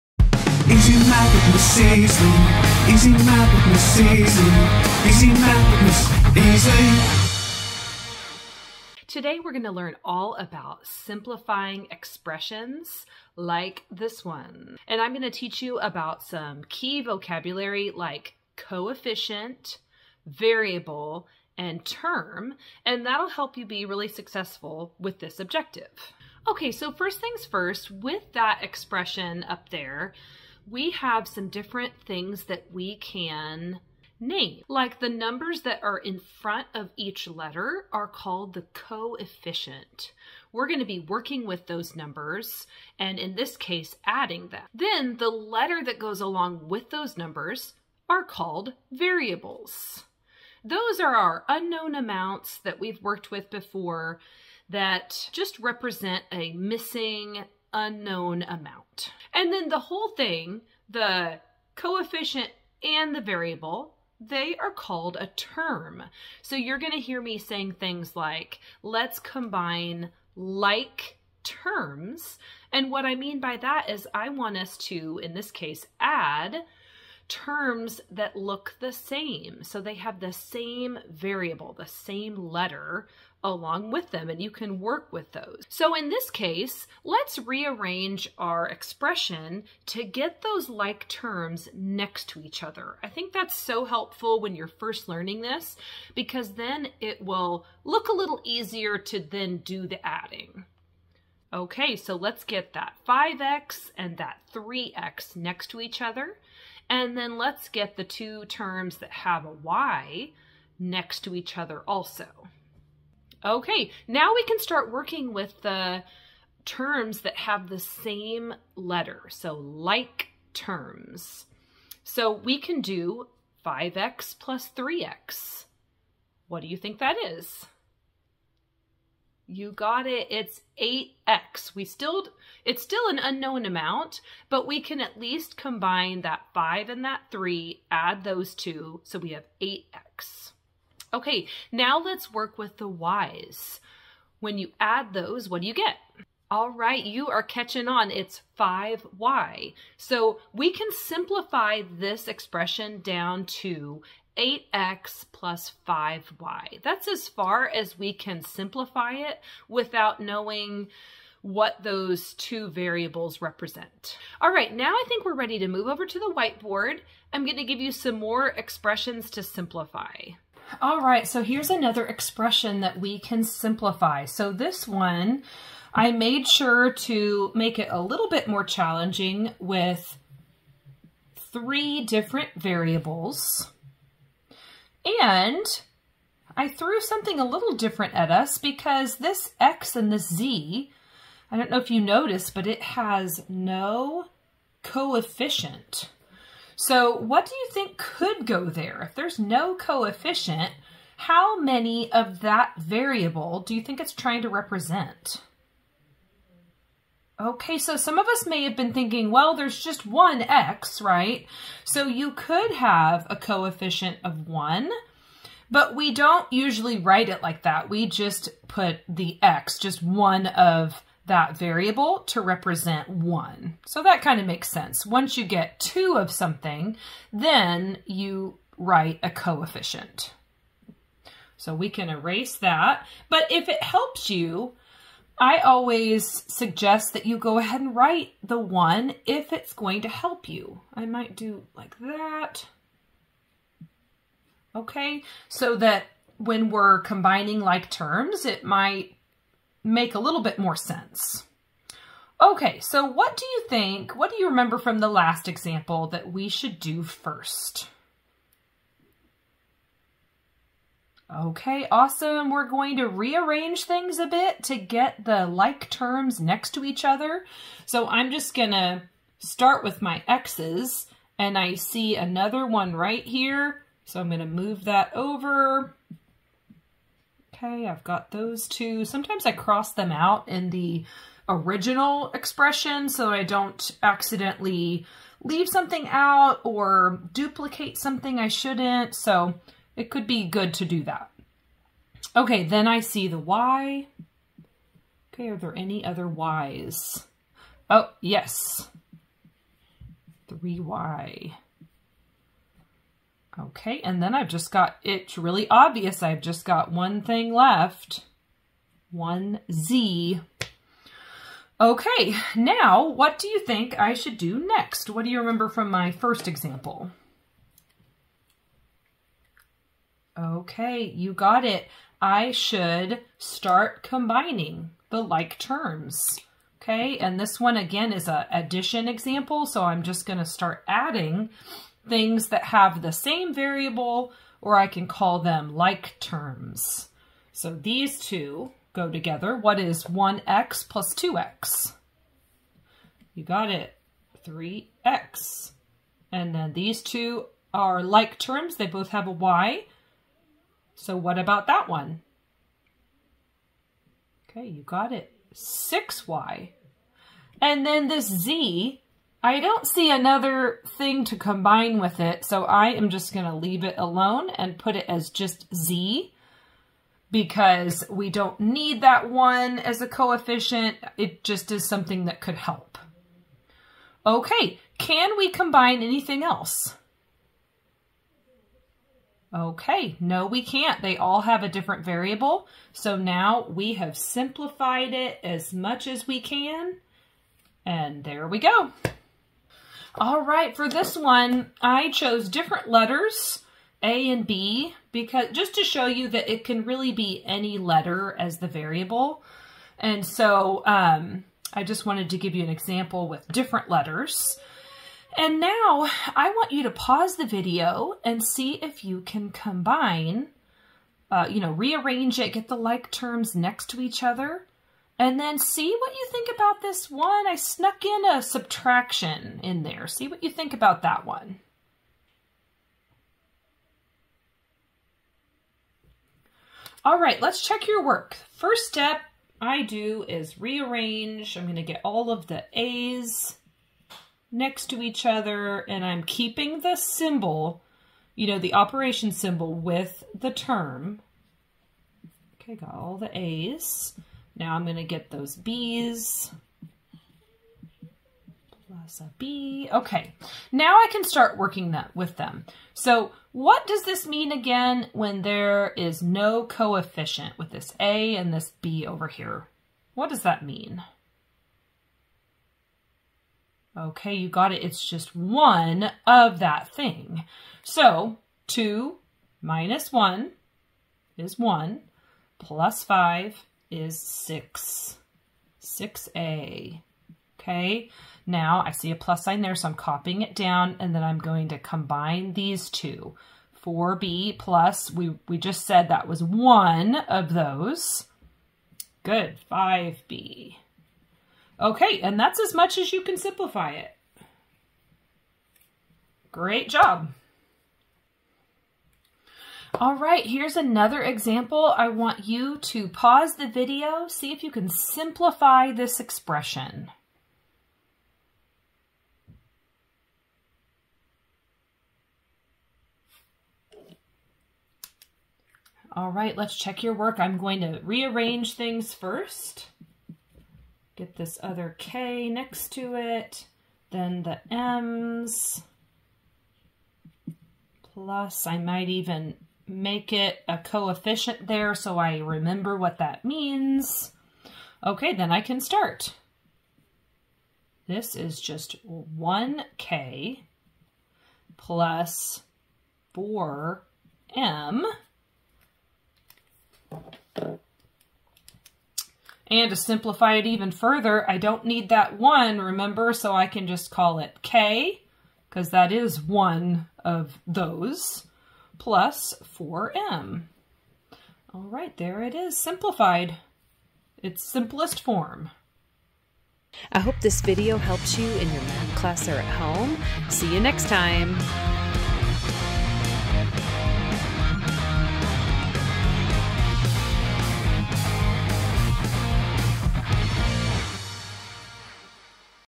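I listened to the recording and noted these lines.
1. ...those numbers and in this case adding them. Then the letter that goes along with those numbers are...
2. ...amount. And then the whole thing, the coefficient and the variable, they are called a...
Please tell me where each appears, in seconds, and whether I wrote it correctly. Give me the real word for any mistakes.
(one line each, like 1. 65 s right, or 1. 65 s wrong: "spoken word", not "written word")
1. 41 s right
2. 58 s right.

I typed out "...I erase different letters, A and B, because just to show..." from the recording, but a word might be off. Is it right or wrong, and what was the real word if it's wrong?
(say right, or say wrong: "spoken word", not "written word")
wrong: "chose", not "erase".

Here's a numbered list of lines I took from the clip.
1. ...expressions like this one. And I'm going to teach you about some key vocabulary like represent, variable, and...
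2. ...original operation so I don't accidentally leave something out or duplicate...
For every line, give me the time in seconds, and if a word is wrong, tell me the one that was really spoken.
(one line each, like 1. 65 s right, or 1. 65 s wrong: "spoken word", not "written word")
1. 11 s wrong: "coefficient", not "represent"
2. 281 s wrong: "expression", not "operation".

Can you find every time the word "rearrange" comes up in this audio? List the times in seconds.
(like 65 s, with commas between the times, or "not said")
87 s, 263 s, 411 s, 430 s, 518 s.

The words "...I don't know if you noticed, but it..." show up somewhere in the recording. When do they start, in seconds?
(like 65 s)
191 s.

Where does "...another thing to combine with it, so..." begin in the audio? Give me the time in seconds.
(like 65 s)
360 s.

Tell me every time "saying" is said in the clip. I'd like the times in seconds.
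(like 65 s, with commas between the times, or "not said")
67 s.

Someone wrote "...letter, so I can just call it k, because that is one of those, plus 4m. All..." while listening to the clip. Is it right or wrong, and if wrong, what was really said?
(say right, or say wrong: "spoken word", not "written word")
wrong: "remember", not "letter".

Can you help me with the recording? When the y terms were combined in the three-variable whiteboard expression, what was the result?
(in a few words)
6y.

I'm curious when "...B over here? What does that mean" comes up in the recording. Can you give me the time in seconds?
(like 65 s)
458 s.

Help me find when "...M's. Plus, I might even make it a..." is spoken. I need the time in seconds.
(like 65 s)
524 s.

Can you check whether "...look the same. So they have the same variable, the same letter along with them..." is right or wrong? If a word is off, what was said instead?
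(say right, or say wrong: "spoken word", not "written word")
right.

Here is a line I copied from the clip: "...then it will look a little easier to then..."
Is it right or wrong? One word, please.
right.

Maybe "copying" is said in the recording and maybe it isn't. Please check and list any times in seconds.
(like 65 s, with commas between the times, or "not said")
479 s.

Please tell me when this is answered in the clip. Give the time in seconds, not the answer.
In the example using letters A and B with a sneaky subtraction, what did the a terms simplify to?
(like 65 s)
475 s.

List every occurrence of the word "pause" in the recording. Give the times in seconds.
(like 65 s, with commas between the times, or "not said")
406 s, 503 s.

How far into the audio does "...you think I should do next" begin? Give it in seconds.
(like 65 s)
313 s.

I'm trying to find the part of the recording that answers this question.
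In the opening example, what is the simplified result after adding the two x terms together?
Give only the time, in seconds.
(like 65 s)
130 s.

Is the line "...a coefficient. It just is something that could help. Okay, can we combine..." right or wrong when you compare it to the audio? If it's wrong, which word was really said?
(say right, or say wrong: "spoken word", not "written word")
right.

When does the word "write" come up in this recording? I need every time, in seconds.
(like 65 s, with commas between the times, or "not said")
216 s, 228 s, 237 s.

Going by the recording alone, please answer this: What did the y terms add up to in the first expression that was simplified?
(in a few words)
5y.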